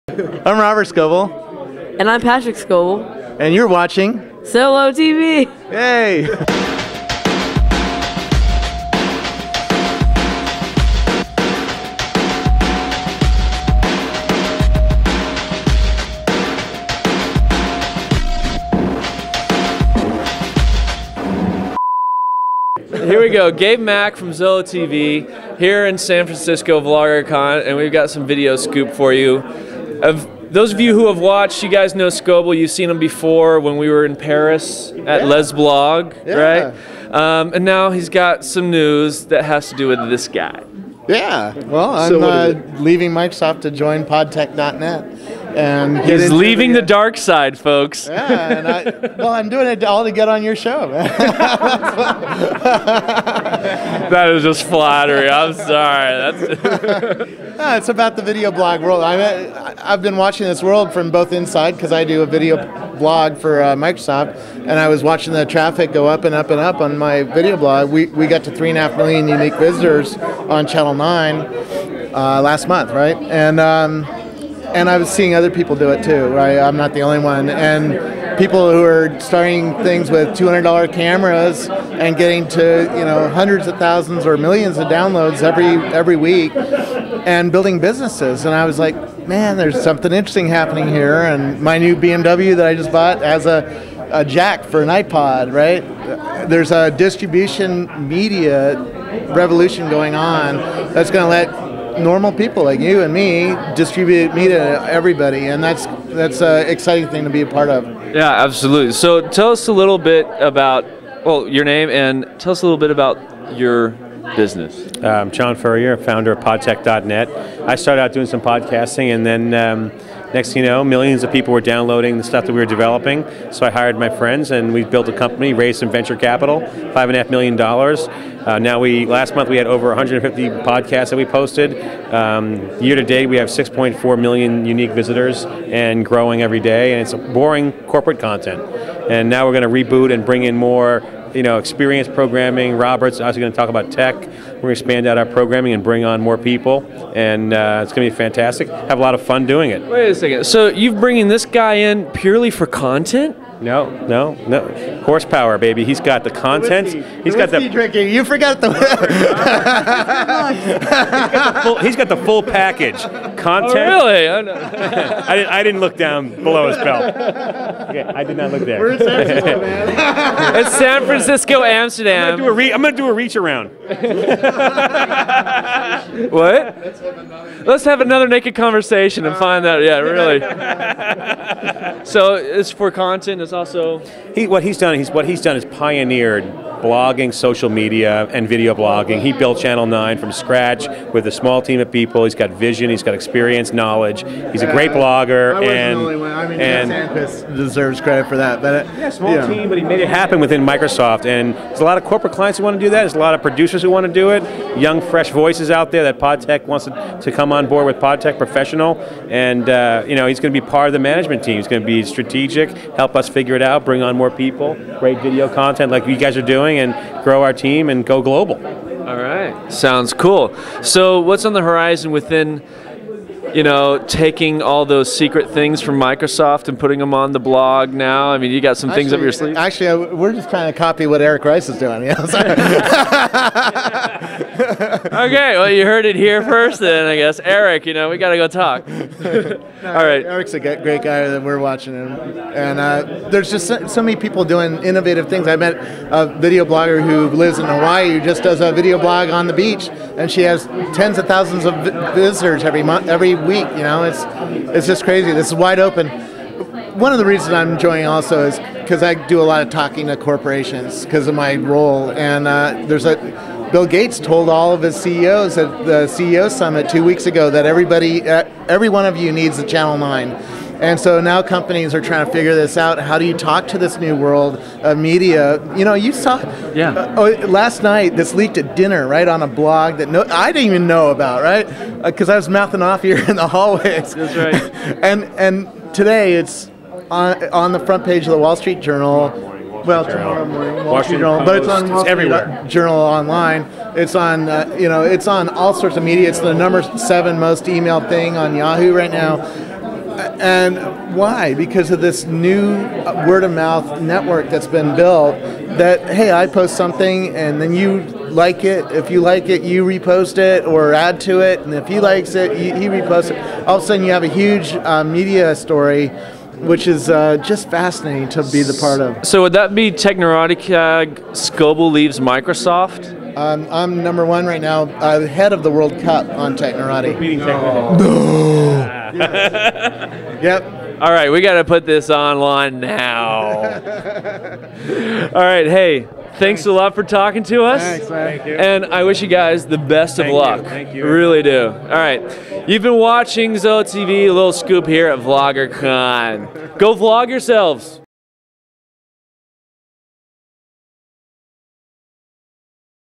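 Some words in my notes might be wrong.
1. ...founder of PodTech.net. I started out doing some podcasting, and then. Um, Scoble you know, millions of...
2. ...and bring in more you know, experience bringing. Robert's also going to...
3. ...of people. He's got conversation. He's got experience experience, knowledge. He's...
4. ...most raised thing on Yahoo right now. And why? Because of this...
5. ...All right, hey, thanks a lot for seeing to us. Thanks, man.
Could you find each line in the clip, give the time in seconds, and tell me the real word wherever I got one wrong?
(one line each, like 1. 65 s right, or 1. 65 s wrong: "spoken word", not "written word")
1. 115 s wrong: "Next", not "Scoble"
2. 140 s wrong: "programming", not "bringing"
3. 191 s wrong: "vision", not "conversation"
4. 297 s wrong: "emailed", not "raised"
5. 333 s wrong: "talking", not "seeing".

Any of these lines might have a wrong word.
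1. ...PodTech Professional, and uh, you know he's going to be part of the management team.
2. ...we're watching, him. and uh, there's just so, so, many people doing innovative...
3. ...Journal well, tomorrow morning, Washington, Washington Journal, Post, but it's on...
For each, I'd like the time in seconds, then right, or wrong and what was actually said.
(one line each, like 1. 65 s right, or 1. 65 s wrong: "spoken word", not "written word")
1. 208 s right
2. 241 s right
3. 288 s right.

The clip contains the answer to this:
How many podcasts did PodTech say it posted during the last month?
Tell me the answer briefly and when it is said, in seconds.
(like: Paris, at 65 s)
150, at 129 s.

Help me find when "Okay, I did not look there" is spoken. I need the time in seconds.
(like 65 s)
167 s.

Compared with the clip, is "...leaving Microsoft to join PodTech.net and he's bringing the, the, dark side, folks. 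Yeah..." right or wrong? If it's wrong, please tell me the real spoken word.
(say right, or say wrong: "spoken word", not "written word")
wrong: "leaving", not "bringing".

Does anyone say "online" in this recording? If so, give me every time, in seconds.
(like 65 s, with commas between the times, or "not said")
292 s, 332 s.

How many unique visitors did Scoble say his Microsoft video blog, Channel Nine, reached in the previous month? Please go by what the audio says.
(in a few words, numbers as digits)
3.5 million.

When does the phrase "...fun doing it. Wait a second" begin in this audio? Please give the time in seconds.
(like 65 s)
149 s.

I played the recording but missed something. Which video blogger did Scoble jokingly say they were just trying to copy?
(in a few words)
Eric Rice.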